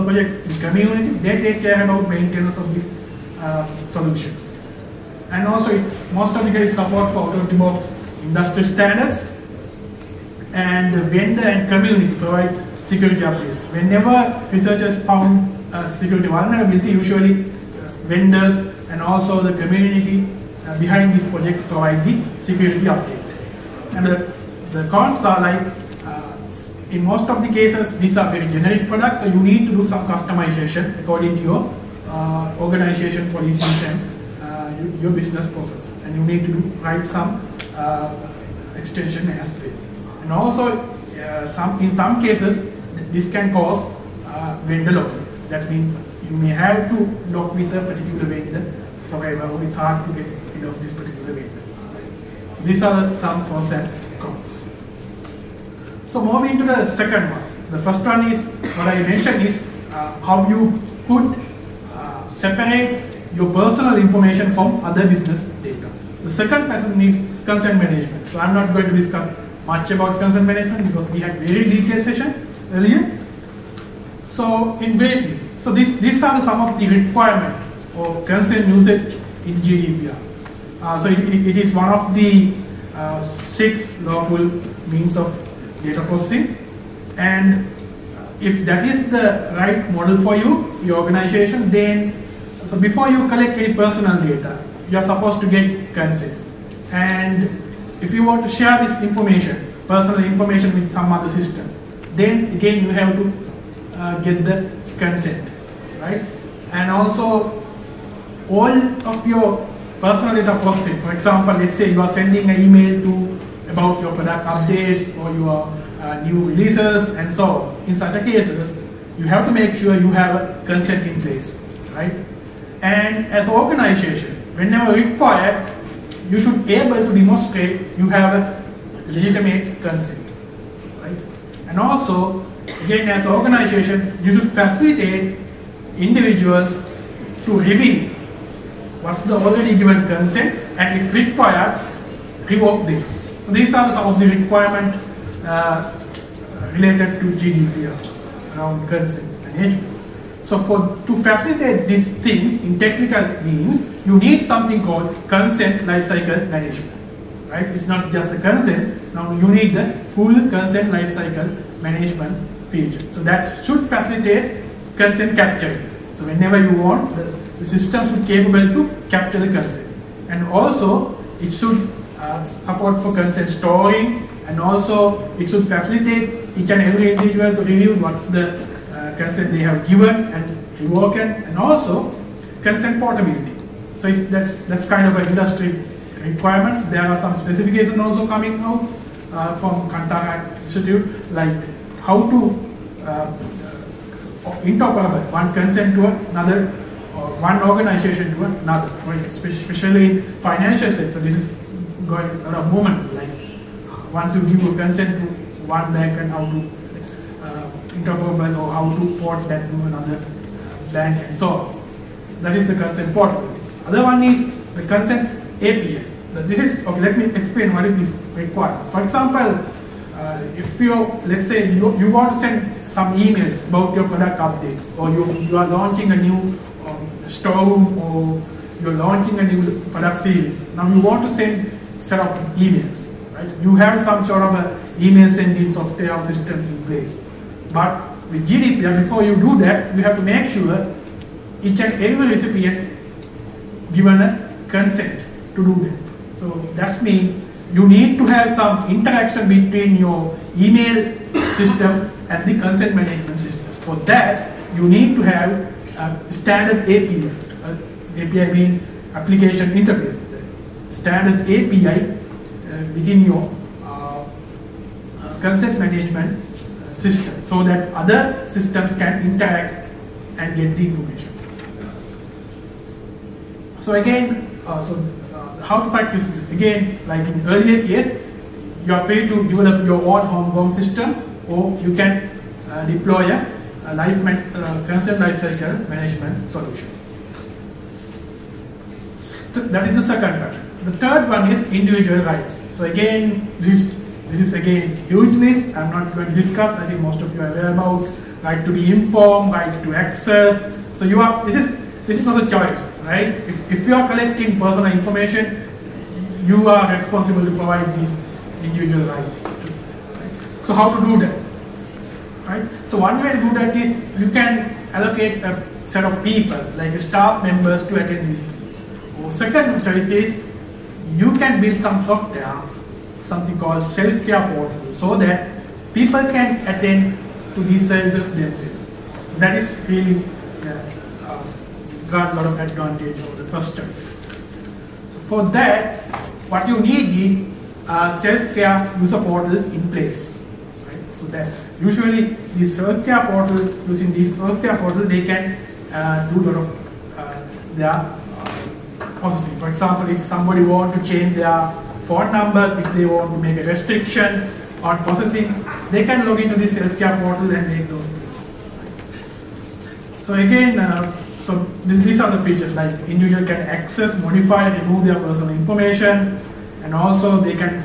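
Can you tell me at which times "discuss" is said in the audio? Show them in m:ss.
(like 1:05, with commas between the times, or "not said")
1:08, 4:56.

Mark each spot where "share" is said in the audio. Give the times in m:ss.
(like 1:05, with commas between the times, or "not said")
1:38.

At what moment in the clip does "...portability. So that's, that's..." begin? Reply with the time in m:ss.
3:02.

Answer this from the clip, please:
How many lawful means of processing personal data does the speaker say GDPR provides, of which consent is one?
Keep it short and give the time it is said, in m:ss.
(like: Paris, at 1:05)
6, at 1:23.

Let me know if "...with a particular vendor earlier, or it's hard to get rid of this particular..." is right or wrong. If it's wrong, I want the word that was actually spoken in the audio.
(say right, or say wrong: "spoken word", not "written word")
wrong: "forever", not "earlier".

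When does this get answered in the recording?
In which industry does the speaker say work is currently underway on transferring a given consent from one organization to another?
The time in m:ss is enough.
3:20.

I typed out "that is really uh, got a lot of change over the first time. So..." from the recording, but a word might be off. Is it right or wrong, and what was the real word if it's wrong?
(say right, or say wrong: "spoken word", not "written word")
wrong: "advantage", not "change".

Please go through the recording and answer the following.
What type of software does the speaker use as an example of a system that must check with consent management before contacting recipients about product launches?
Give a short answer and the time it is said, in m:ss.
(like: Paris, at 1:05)
email sending software, at 3:54.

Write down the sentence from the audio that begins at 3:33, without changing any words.
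Other one is the consent API.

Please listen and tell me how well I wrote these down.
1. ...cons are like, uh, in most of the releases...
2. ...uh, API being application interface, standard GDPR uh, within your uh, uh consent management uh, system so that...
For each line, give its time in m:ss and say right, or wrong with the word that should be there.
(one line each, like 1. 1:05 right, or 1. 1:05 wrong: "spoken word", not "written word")
1. 0:24 wrong: "cases", not "releases"
2. 4:17 wrong: "API", not "GDPR".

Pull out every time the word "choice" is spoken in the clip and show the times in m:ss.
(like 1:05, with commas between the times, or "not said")
5:02, 5:19.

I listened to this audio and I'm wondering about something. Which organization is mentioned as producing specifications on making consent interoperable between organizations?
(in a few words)
Kantara Institute.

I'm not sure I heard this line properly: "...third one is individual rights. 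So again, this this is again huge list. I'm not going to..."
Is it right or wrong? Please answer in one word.
right.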